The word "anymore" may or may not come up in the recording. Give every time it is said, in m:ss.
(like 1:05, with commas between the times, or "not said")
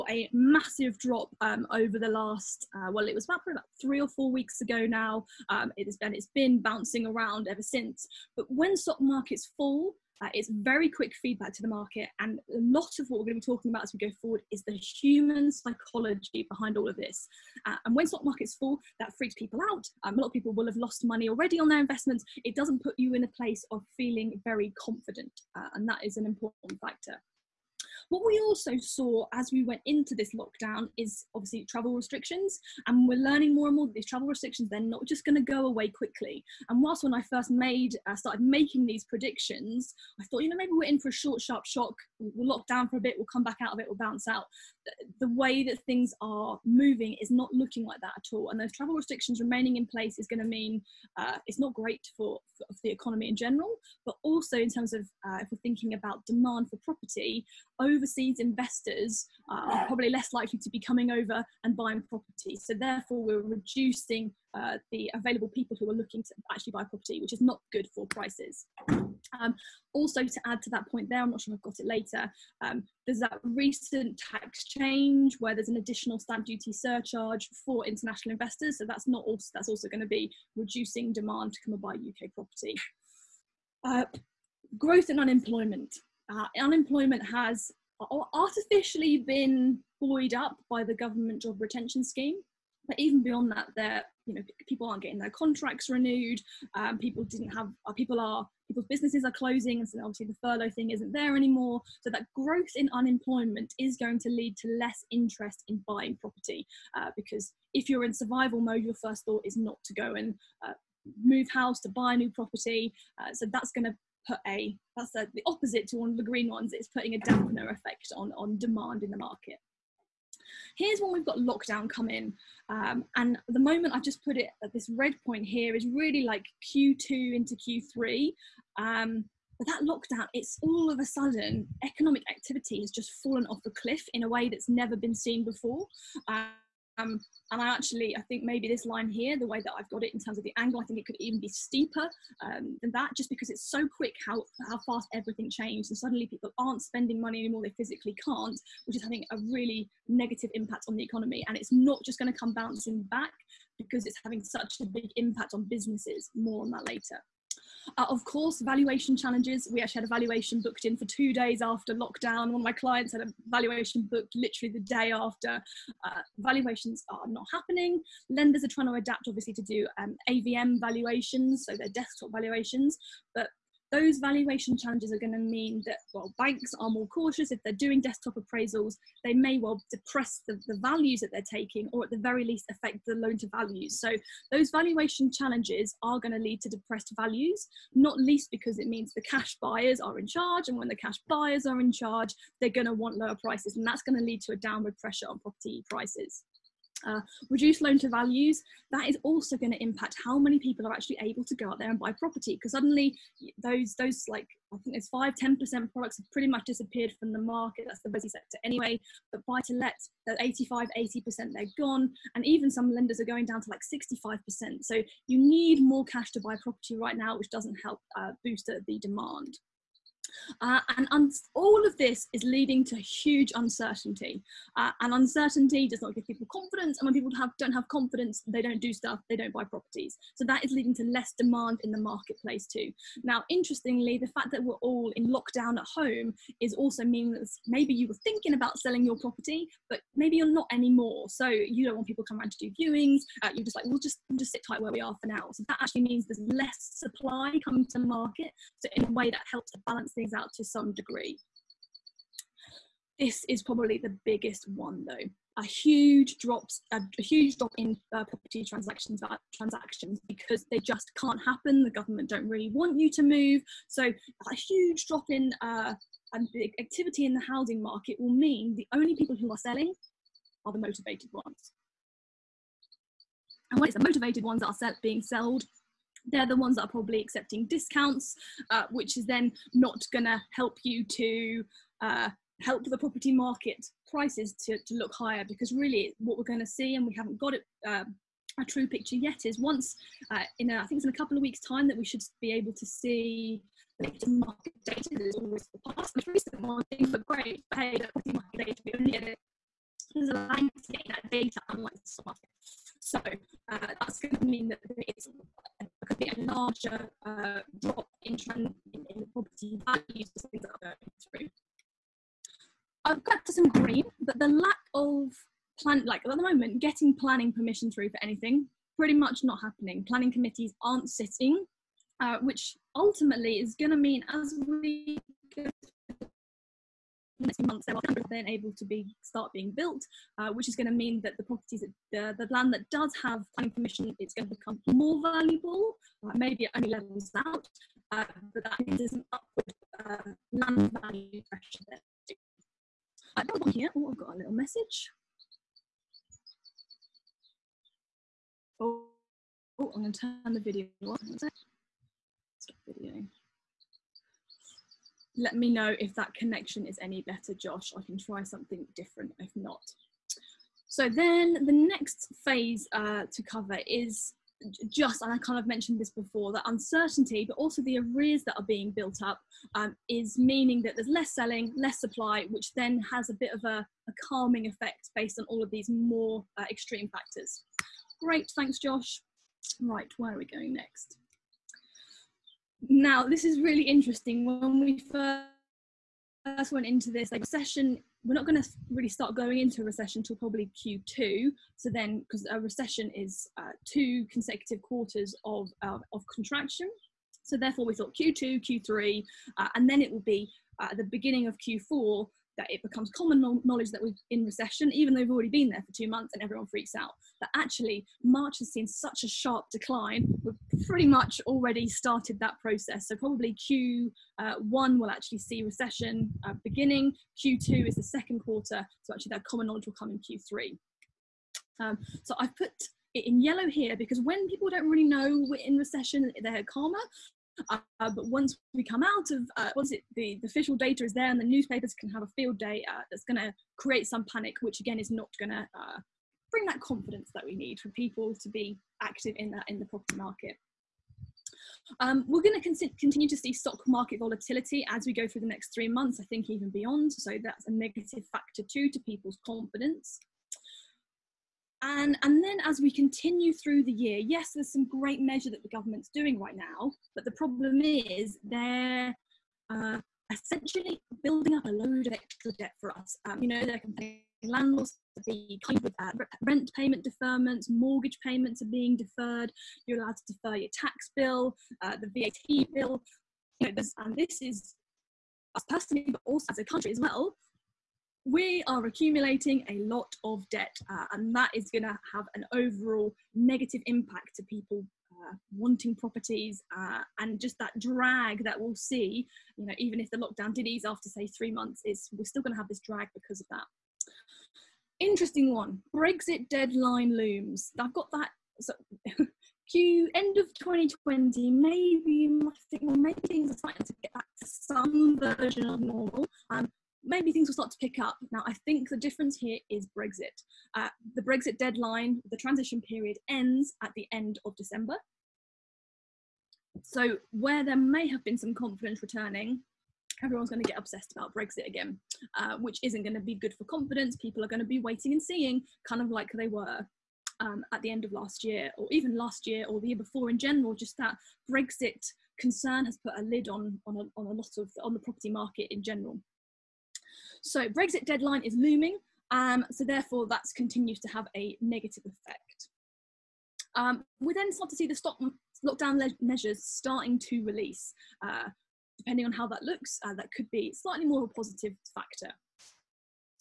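1:41, 2:27, 4:00.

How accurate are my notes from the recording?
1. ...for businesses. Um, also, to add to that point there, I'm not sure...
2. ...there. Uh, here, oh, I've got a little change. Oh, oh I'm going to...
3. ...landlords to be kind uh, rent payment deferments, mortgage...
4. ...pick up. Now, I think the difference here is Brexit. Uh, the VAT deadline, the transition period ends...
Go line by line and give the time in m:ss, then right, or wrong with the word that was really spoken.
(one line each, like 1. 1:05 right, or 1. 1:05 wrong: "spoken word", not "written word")
1. 1:07 wrong: "prices", not "businesses"
2. 5:41 wrong: "message", not "change"
3. 7:44 right
4. 8:27 wrong: "Brexit", not "VAT".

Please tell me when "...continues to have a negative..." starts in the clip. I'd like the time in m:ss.
9:00.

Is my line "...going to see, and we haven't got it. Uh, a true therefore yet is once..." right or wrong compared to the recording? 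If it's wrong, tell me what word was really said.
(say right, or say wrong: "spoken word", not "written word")
wrong: "picture", not "therefore".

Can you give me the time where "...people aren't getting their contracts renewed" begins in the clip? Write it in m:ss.
1:34.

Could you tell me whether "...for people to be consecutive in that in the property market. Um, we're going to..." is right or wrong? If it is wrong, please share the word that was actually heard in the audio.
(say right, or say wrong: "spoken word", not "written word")
wrong: "active", not "consecutive".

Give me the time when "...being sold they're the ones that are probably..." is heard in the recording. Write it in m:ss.
4:35.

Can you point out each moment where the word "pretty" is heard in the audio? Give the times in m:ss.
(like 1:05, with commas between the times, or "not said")
3:26, 5:18, 6:50.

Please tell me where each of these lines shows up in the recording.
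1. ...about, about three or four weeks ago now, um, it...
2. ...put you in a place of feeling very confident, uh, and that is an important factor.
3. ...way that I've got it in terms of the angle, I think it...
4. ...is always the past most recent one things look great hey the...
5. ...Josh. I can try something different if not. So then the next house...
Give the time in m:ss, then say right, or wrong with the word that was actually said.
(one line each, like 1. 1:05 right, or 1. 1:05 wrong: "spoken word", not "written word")
1. 0:03 right
2. 0:22 right
3. 2:19 right
4. 4:55 right
5. 5:57 wrong: "phase", not "house".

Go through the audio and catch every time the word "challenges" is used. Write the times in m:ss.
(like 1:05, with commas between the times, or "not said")
2:39, 2:54, 3:05.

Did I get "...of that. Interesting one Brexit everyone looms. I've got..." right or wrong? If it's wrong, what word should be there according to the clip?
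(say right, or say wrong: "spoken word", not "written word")
wrong: "deadline", not "everyone".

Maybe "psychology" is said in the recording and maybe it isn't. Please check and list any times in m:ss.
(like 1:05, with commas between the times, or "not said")
0:15.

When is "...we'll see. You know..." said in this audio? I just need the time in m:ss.
8:08.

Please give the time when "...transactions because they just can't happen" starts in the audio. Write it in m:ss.
4:19.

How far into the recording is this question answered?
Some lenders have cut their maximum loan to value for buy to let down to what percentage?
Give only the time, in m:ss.
3:33.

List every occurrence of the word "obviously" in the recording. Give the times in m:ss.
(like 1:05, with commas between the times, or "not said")
0:31, 1:40, 2:49.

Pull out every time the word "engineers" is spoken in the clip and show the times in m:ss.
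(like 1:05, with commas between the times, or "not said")
not said.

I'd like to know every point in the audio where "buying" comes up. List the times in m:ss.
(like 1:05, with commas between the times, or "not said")
1:01, 1:45.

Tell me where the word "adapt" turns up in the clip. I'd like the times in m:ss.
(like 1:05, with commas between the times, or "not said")
2:48.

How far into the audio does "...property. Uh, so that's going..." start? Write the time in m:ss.
1:52.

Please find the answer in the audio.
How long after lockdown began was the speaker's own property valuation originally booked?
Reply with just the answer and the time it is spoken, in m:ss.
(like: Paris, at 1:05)
2 days, at 2:41.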